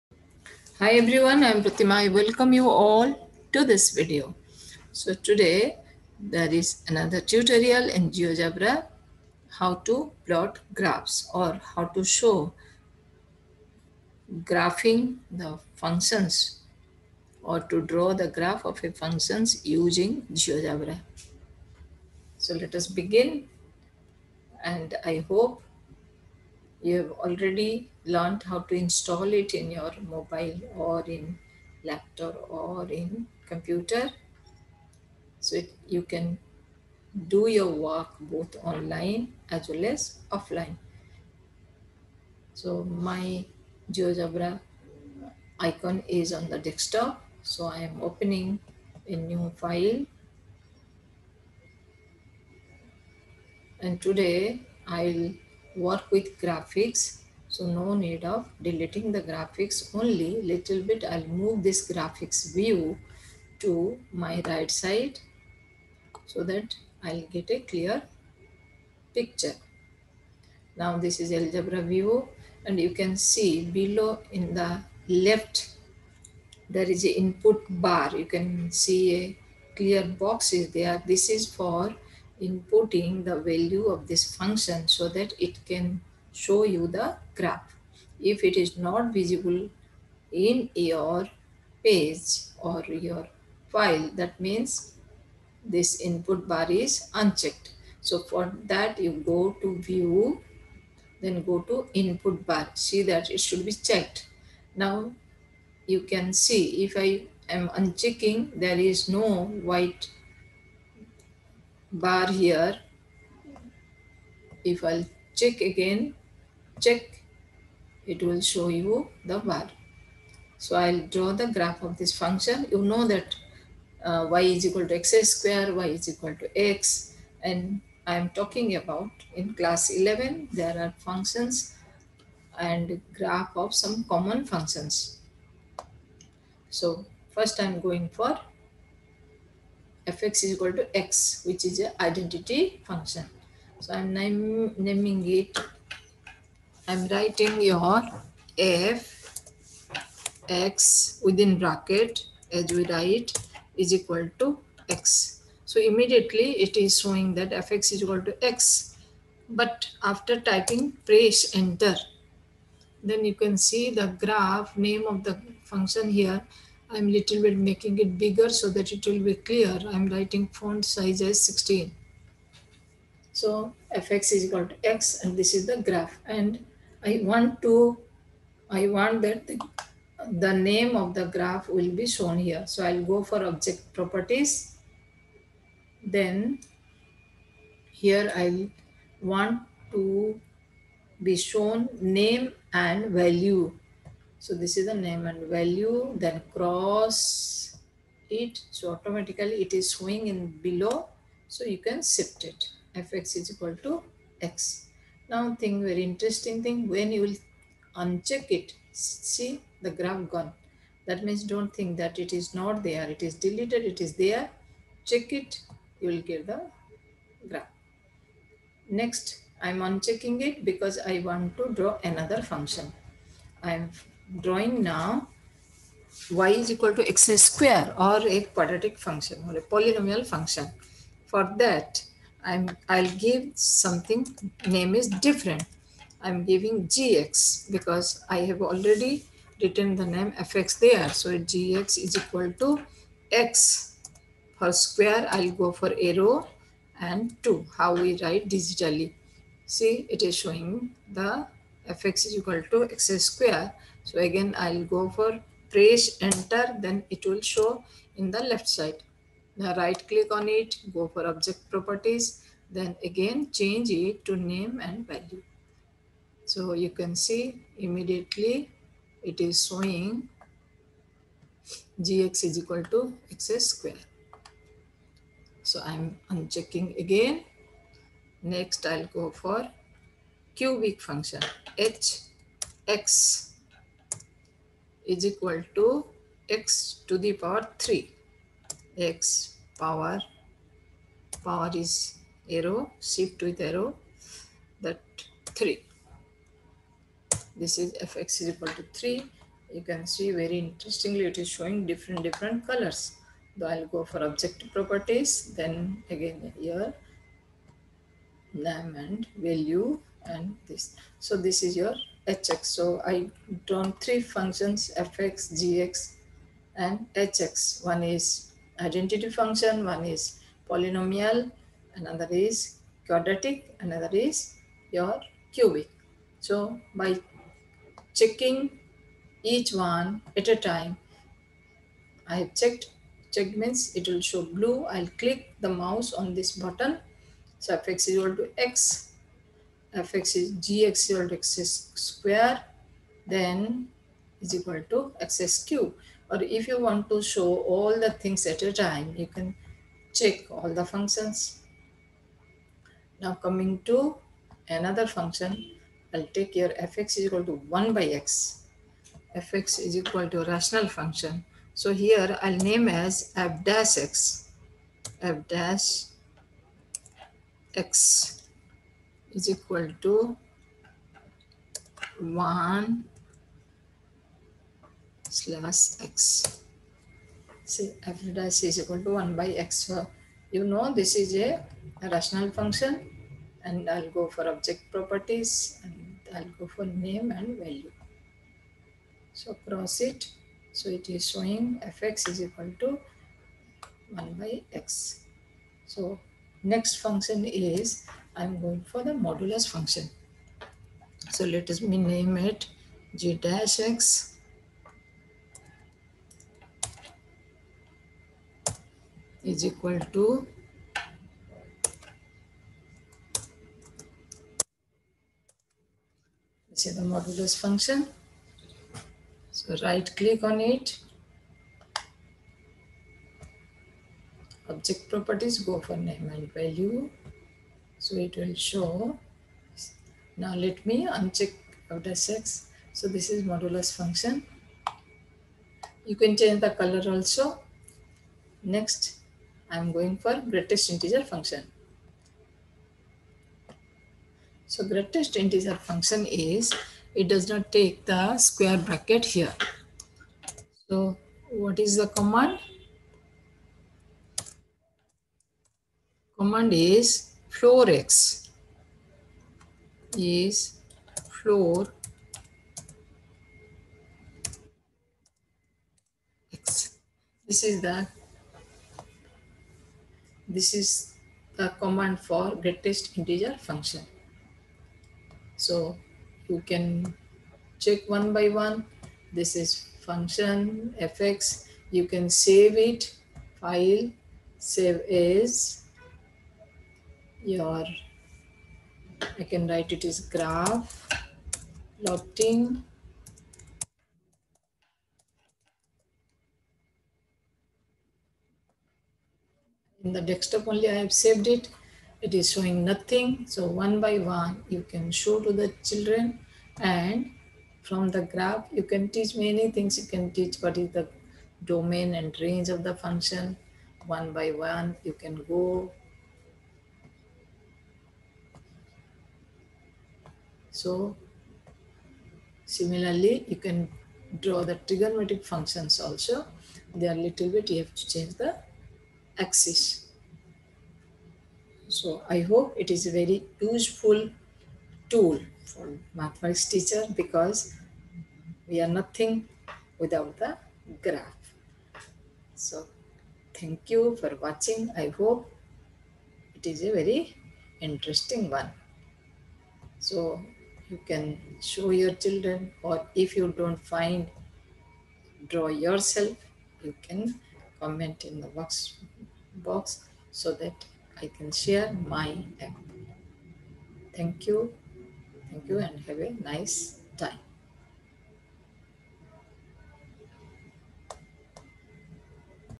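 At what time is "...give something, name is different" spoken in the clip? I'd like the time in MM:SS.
03:53.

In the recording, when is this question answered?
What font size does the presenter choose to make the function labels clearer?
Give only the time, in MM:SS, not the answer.
02:51.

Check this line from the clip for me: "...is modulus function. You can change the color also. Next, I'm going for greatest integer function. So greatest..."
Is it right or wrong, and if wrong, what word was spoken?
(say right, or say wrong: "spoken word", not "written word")
right.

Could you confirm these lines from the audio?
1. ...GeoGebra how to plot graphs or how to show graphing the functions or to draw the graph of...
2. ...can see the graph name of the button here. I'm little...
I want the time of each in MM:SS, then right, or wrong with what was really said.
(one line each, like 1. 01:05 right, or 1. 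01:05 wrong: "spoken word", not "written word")
1. 00:08 right
2. 02:43 wrong: "function", not "button".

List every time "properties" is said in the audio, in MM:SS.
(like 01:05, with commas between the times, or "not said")
03:03, 04:21, 05:04, 06:24, 07:05.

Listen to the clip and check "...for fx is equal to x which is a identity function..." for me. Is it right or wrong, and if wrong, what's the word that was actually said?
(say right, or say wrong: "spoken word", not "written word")
right.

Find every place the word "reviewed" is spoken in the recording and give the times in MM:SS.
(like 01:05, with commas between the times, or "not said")
not said.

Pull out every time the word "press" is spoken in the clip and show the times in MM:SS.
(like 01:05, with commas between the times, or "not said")
02:41, 04:15.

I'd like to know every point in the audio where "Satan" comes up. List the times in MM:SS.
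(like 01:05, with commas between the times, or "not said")
not said.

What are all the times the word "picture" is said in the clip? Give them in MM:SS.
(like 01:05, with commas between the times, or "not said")
01:09.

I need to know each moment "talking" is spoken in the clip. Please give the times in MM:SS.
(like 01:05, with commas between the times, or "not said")
02:08.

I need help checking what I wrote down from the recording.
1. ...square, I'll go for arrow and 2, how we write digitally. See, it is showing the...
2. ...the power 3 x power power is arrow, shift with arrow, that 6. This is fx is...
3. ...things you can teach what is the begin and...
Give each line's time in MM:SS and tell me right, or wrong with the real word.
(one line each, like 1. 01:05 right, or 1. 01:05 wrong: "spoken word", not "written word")
1. 04:04 right
2. 04:47 wrong: "3", not "6"
3. 08:29 wrong: "domain", not "begin".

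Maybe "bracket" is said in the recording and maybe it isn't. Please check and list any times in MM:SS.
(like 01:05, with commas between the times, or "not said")
02:31, 07:28.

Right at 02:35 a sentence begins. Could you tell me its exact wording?
So immediately it is showing that fx is equal to x.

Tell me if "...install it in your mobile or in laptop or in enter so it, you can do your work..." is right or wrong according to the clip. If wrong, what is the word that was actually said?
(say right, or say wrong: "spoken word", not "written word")
wrong: "computer", not "enter".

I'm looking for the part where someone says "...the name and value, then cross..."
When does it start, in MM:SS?
03:14.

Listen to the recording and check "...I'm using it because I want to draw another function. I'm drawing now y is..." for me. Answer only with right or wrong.
wrong.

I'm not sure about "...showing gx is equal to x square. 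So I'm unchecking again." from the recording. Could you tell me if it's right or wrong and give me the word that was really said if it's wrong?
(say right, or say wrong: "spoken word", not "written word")
right.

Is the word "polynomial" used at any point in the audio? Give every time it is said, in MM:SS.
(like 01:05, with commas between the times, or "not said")
03:49, 05:20.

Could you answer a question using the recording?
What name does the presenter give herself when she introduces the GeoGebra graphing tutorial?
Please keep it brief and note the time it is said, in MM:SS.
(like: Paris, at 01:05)
Pratima, at 00:01.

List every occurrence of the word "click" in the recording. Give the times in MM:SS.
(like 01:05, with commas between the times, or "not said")
04:20, 05:35, 07:00.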